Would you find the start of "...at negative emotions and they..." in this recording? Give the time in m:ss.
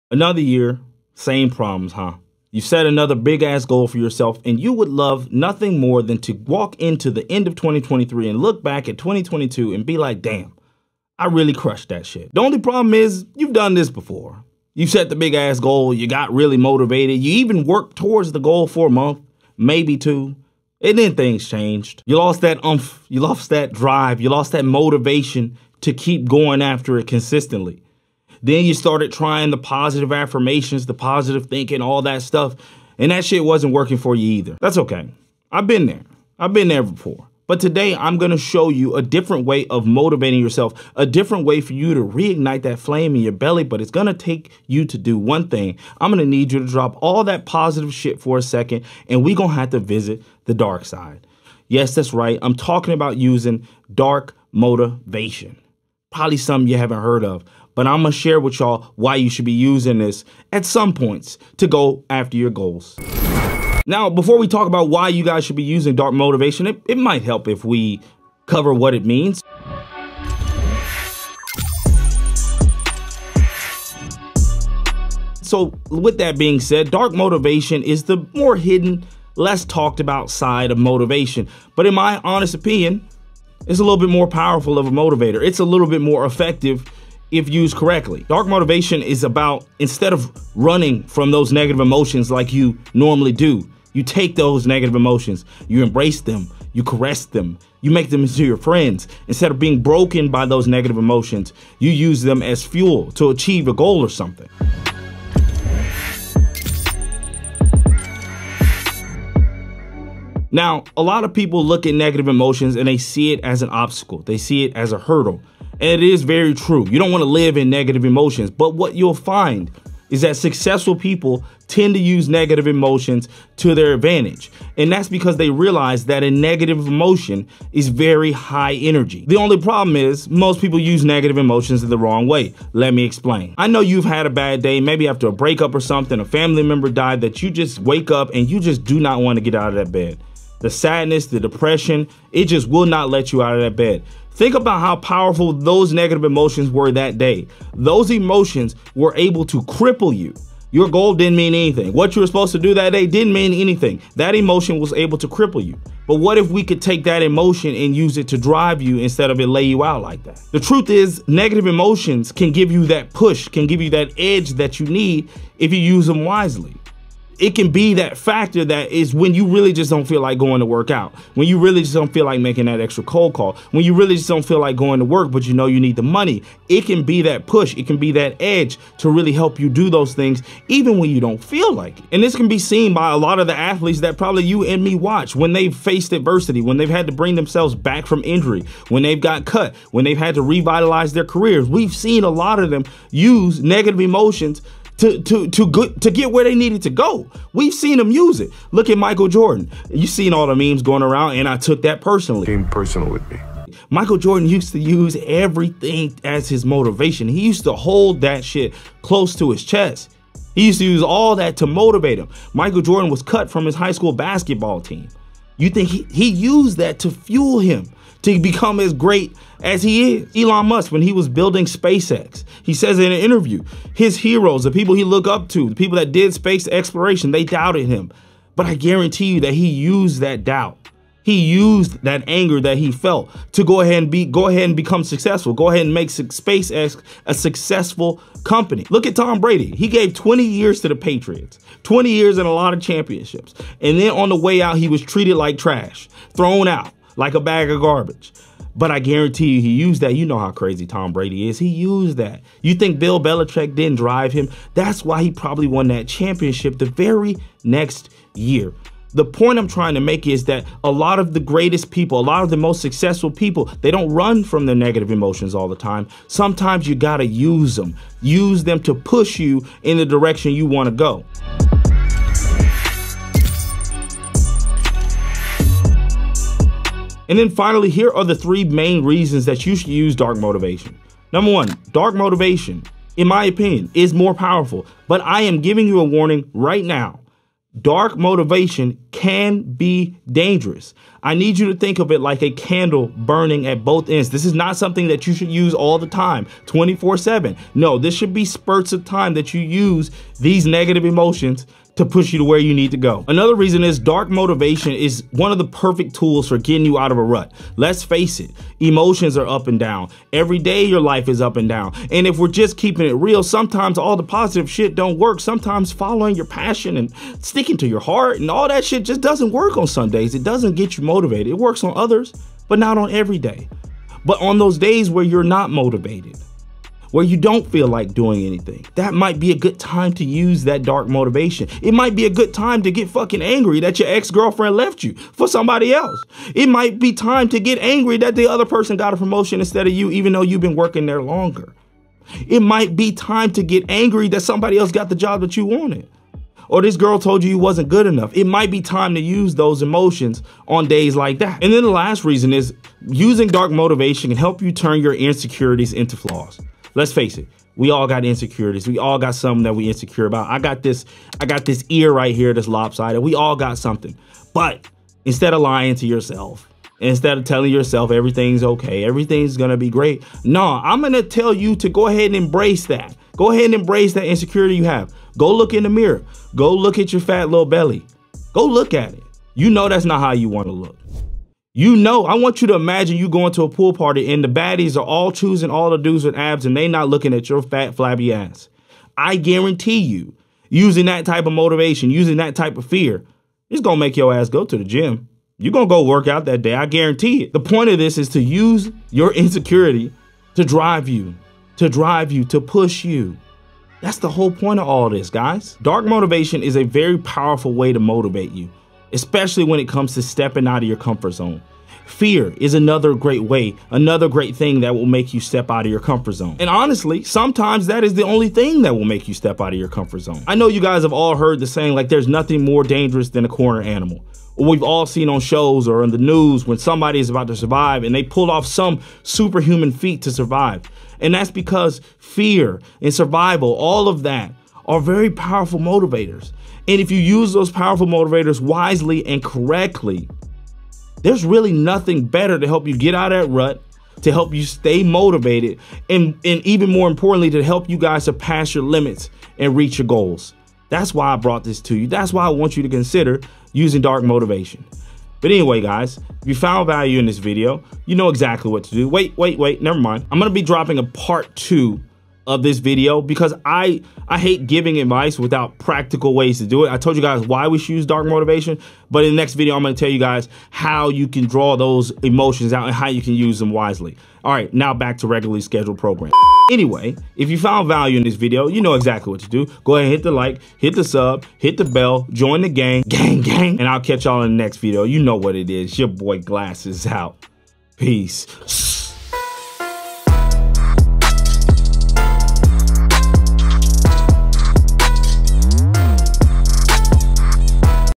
1:51.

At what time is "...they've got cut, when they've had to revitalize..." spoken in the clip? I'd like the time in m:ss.
3:09.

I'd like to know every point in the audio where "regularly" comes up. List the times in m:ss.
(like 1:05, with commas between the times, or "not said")
7:55.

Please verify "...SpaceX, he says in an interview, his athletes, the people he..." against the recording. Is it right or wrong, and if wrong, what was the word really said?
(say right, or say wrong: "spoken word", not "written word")
wrong: "heroes", not "athletes".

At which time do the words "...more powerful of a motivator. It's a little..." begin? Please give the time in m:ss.
1:24.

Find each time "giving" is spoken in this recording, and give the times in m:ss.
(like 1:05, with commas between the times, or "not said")
4:45, 7:44.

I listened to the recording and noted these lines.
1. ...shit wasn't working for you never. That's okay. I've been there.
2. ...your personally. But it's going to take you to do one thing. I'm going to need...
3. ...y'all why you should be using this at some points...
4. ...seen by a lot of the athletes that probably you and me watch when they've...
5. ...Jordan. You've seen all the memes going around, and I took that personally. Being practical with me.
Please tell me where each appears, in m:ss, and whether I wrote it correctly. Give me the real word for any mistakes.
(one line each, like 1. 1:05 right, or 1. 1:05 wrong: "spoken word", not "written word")
1. 0:33 wrong: "either", not "never"
2. 0:43 wrong: "belly", not "personally"
3. 0:58 right
4. 3:02 right
5. 3:19 wrong: "personal", not "practical".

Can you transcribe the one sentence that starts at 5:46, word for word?
Or this girl told you you wasn't good enough.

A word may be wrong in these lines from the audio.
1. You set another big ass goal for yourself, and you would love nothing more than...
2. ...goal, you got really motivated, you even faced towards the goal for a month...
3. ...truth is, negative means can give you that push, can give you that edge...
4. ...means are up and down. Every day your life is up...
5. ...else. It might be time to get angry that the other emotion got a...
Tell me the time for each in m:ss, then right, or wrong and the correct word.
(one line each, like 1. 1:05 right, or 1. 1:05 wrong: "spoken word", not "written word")
1. 0:02 right
2. 0:15 wrong: "worked", not "faced"
3. 2:40 wrong: "emotions", not "means"
4. 5:08 wrong: "emotions", not "means"
5. 5:35 wrong: "person", not "emotion".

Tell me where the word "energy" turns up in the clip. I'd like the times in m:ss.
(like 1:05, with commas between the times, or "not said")
2:08.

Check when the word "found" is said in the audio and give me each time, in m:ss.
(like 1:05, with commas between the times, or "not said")
7:36, 7:57.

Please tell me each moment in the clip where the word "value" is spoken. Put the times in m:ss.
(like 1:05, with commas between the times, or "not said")
7:36, 7:57.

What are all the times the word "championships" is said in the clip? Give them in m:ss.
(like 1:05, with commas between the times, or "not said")
4:02, 4:16.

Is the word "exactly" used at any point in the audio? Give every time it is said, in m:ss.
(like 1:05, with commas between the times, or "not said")
7:38, 7:58.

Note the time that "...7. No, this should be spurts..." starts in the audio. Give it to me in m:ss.
4:57.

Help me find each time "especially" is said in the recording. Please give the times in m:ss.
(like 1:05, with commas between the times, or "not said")
6:49.